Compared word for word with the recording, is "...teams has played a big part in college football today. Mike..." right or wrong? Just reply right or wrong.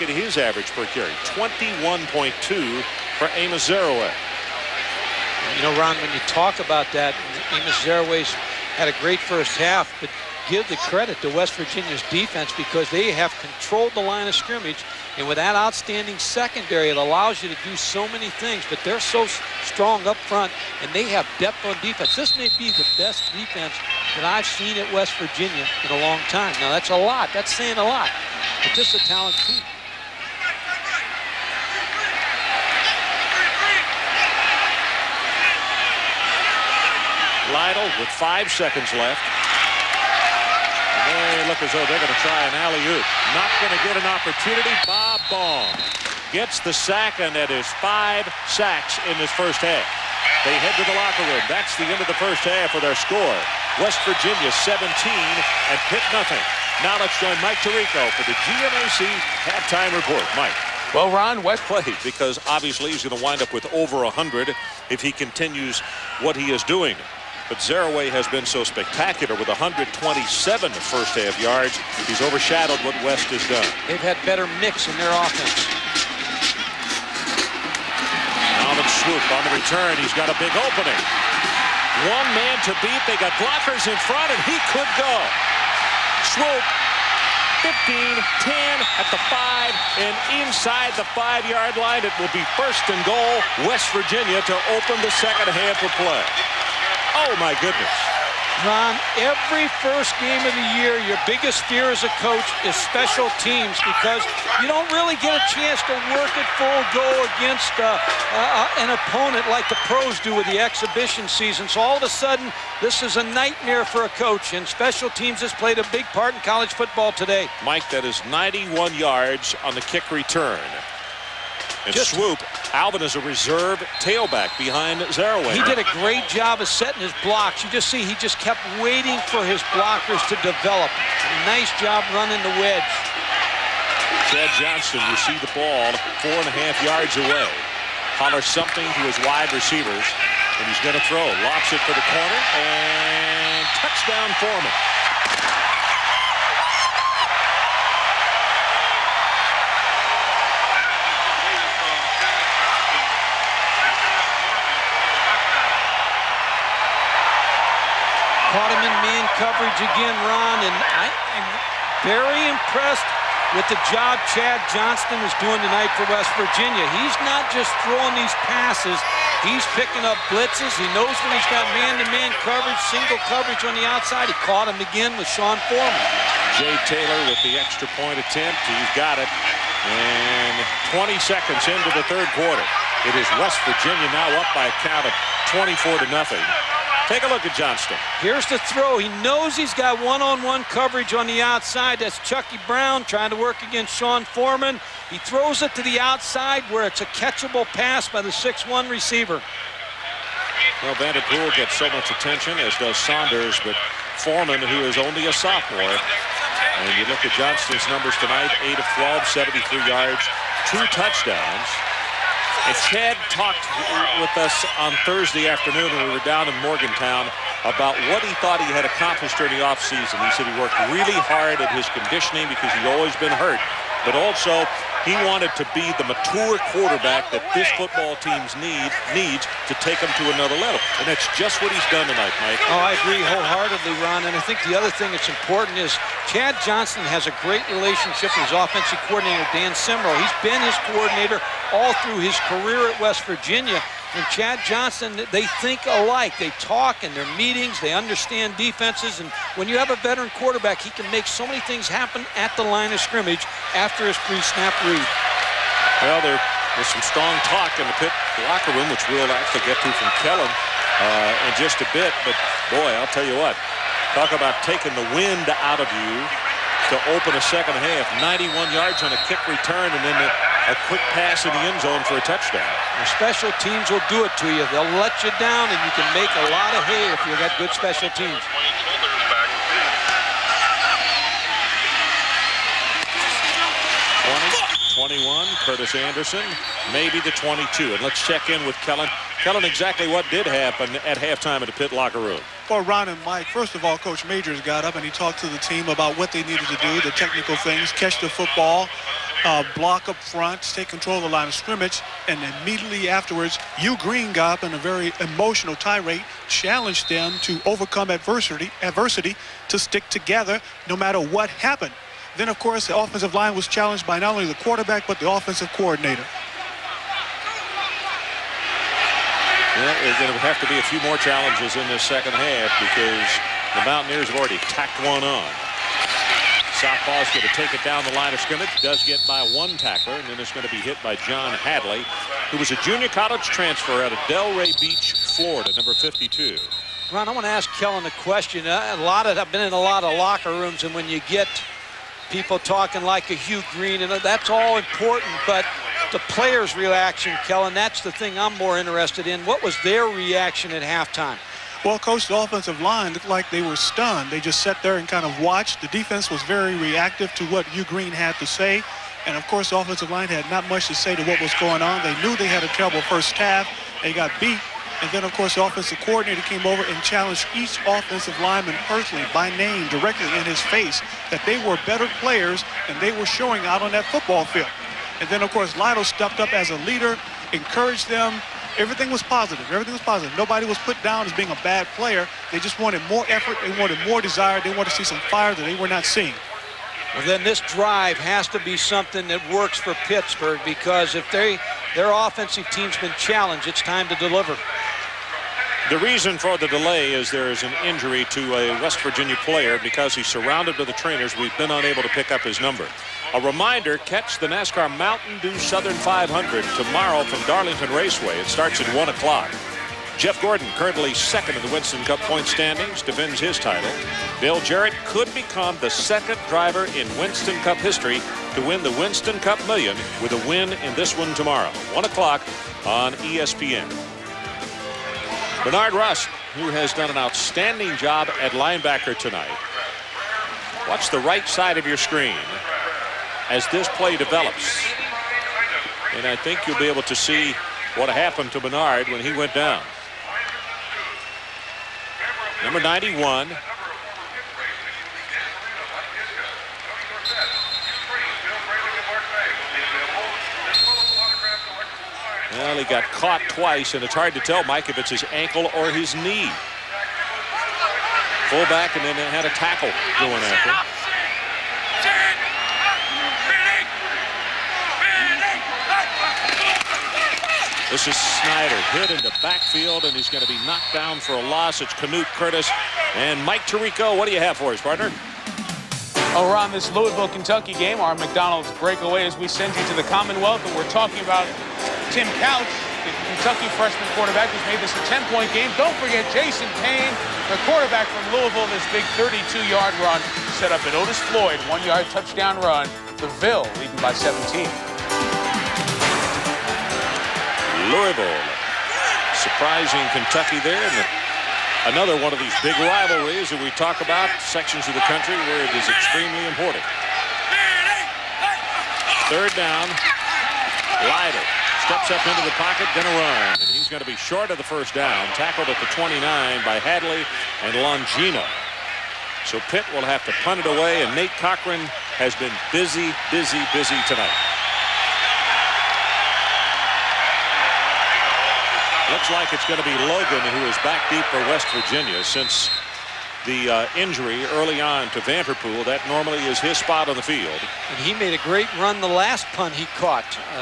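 right.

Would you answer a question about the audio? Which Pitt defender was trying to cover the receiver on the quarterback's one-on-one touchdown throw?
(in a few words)
Chucky Brown.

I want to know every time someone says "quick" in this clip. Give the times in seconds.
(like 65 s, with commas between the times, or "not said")
270 s.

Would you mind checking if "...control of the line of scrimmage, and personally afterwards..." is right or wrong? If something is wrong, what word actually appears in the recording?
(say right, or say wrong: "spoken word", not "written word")
wrong: "immediately", not "personally".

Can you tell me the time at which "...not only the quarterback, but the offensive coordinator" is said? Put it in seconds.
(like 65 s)
314 s.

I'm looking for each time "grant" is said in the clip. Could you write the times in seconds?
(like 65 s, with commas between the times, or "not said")
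not said.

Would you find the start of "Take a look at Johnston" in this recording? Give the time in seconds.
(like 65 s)
187 s.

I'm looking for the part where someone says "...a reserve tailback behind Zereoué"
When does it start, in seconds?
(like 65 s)
123 s.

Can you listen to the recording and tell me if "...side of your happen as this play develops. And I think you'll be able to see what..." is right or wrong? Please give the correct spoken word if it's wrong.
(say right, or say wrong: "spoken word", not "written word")
wrong: "screen", not "happen".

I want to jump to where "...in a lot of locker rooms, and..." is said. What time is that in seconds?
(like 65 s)
339 s.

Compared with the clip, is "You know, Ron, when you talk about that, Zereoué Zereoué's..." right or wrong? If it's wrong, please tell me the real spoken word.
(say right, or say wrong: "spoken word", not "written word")
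wrong: "Amos", not "Zereoué".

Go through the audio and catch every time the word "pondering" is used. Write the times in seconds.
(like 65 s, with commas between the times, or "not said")
not said.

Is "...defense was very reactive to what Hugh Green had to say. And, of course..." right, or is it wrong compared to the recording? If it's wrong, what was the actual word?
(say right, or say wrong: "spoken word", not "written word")
right.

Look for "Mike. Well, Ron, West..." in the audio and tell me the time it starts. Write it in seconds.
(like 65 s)
60 s.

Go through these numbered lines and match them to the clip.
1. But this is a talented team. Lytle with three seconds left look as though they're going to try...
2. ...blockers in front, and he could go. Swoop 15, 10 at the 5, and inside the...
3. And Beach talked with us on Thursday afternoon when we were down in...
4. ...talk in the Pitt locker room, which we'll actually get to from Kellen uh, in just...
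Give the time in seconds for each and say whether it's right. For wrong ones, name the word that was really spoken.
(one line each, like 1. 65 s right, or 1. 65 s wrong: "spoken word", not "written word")
1. 28 s wrong: "five", not "three"
2. 83 s right
3. 212 s wrong: "Chad", not "Beach"
4. 257 s right.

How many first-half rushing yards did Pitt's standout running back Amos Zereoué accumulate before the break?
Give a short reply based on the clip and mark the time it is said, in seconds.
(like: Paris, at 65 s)
127, at 69 s.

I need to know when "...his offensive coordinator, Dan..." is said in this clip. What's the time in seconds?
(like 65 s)
238 s.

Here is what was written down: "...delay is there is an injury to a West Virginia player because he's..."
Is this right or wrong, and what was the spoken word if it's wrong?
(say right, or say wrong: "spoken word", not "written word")
right.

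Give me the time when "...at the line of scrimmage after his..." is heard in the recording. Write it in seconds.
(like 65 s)
252 s.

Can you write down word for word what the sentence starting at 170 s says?
He knows when he's got man-to-man -man coverage, single coverage on the outside.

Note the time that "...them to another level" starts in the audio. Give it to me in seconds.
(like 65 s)
229 s.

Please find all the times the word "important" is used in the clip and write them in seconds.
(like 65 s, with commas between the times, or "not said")
235 s, 344 s, 506 s.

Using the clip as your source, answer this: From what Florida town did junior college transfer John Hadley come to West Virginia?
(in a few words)
Delray Beach.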